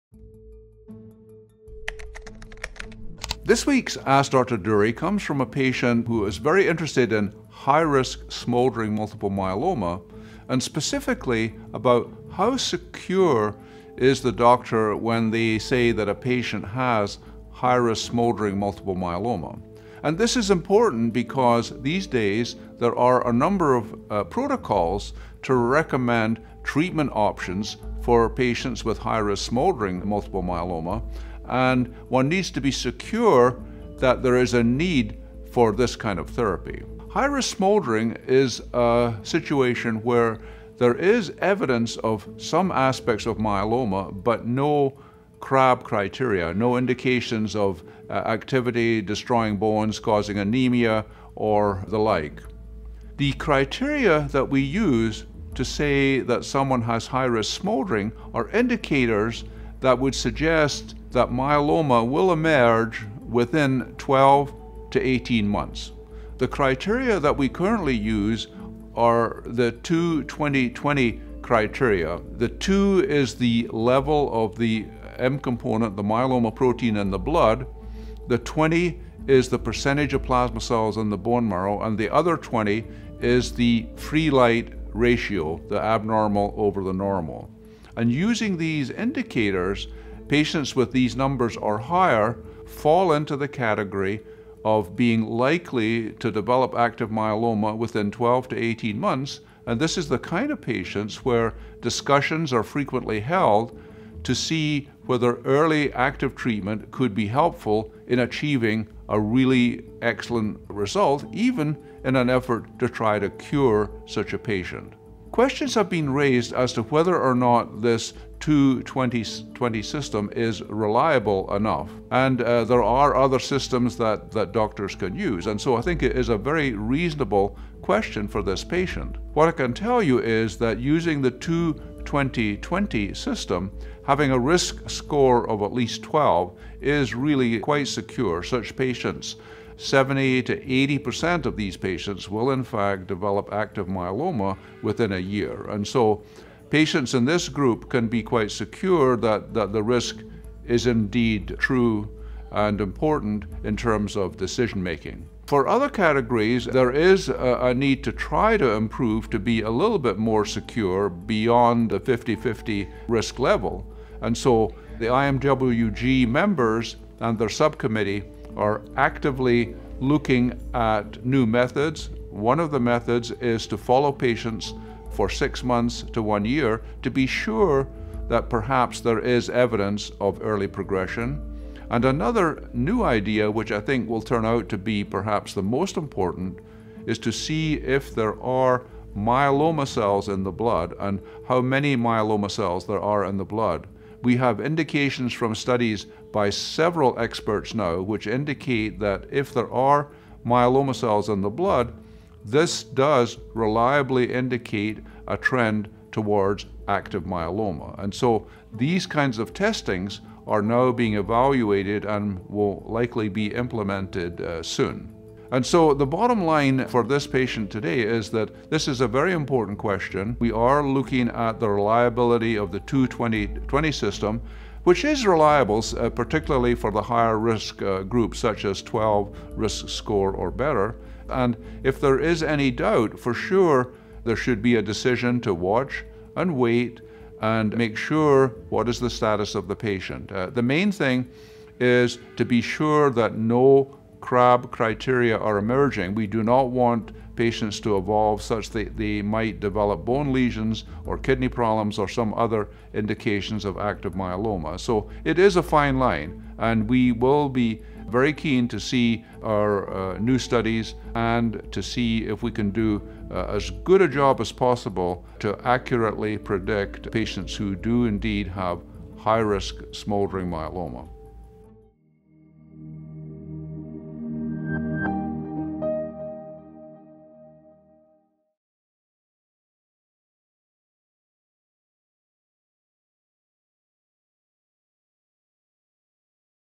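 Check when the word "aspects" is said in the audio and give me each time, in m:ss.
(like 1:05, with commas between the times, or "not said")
0:42.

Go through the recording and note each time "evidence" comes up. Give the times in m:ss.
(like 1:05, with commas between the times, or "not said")
0:41, 2:59.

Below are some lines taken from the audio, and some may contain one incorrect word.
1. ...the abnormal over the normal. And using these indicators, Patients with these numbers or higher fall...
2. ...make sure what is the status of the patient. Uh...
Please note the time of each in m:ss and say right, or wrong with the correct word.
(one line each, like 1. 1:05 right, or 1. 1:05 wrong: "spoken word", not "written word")
1. 1:25 right
2. 3:57 right.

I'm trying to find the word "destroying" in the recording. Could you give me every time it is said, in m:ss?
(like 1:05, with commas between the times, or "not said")
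0:49.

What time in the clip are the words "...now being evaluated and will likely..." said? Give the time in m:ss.
3:30.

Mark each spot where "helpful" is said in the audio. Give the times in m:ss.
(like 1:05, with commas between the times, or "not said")
1:47.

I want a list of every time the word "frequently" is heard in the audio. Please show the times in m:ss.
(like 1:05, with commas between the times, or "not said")
1:42.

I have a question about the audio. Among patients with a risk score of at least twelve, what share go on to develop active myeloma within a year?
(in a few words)
70 to 80%.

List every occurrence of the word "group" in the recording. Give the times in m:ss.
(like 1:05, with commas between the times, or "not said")
2:27, 3:48.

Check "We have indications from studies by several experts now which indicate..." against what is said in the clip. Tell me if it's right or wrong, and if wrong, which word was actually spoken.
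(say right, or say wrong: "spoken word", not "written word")
right.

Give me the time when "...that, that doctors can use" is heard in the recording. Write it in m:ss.
2:03.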